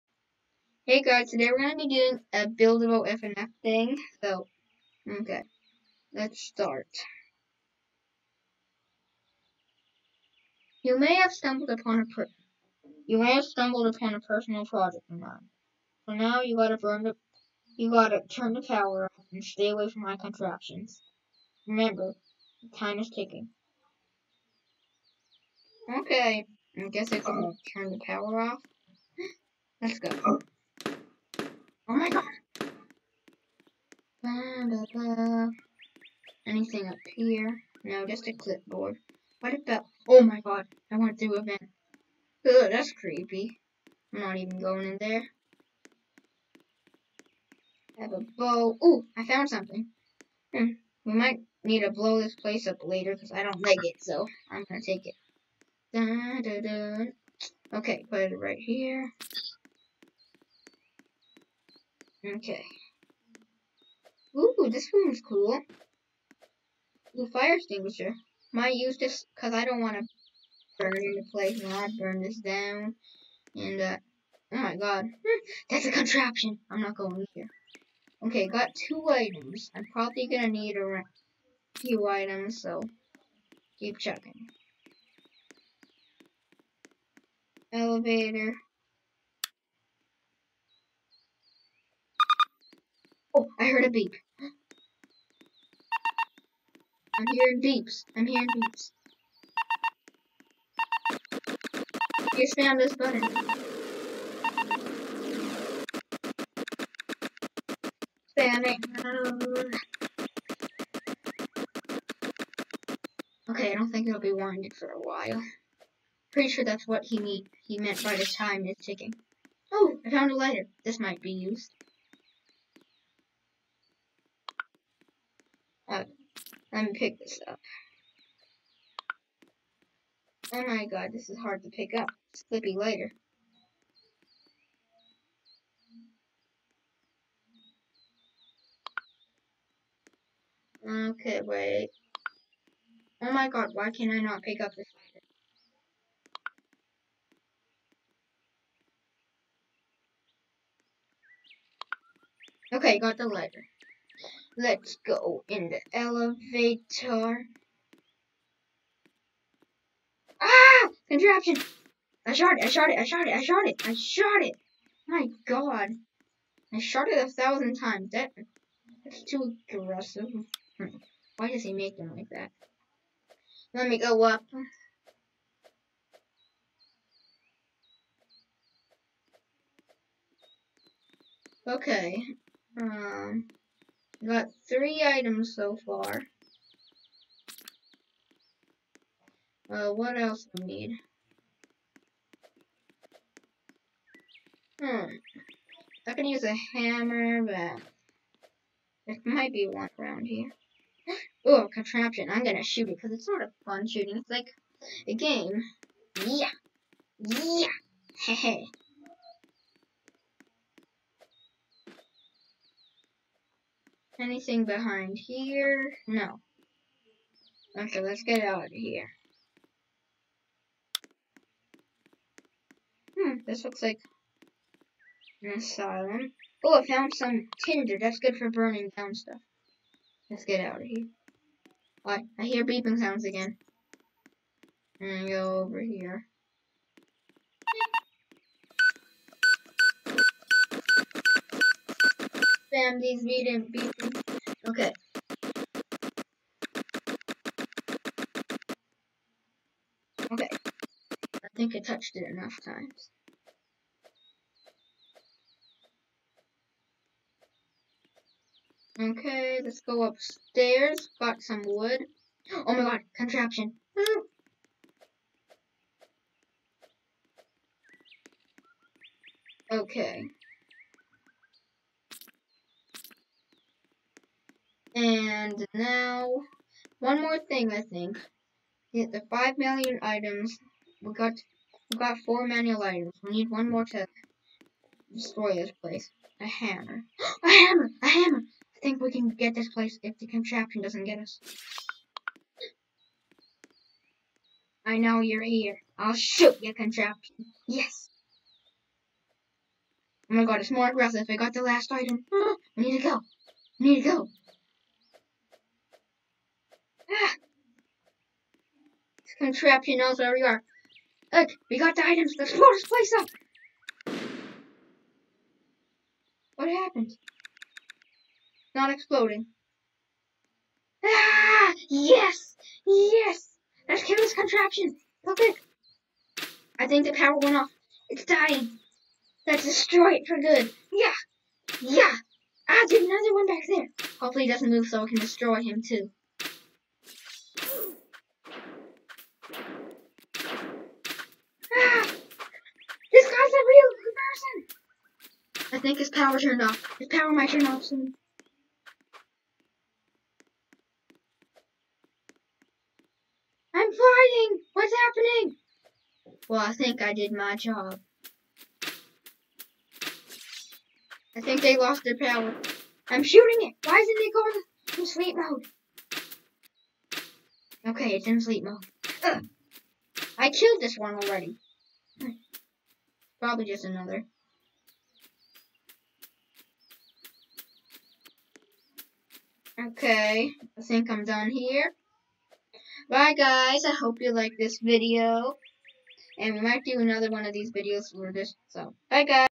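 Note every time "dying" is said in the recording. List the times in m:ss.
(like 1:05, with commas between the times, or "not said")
5:28.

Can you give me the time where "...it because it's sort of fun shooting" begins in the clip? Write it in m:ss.
3:22.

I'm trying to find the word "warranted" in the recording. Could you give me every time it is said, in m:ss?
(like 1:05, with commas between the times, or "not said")
1:54.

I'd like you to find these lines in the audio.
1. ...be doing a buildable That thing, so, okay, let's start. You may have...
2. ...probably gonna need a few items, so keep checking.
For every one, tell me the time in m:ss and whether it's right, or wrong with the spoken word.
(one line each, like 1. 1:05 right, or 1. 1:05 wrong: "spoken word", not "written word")
1. 0:01 wrong: "FNAF", not "That"
2. 1:19 right.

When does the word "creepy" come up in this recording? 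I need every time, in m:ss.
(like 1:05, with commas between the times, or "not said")
0:42.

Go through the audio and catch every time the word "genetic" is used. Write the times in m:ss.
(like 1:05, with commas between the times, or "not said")
not said.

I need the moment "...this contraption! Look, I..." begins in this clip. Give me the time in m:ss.
5:24.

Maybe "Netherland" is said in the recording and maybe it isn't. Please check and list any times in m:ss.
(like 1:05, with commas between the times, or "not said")
not said.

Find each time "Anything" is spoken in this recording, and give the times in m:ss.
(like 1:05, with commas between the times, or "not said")
0:36, 3:34.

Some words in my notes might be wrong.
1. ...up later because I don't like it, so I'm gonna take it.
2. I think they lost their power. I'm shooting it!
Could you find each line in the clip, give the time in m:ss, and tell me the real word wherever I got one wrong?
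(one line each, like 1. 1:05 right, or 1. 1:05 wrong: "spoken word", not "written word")
1. 0:52 right
2. 6:01 right.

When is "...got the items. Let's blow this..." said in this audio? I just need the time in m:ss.
5:11.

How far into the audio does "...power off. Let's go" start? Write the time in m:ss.
0:28.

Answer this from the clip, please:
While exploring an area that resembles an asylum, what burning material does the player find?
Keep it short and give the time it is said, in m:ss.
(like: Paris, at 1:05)
tinder, at 3:47.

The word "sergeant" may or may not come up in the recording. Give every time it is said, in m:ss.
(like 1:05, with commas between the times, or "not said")
not said.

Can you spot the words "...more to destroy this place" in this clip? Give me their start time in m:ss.
4:43.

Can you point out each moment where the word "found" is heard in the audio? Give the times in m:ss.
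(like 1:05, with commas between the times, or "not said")
0:49, 2:00, 3:46.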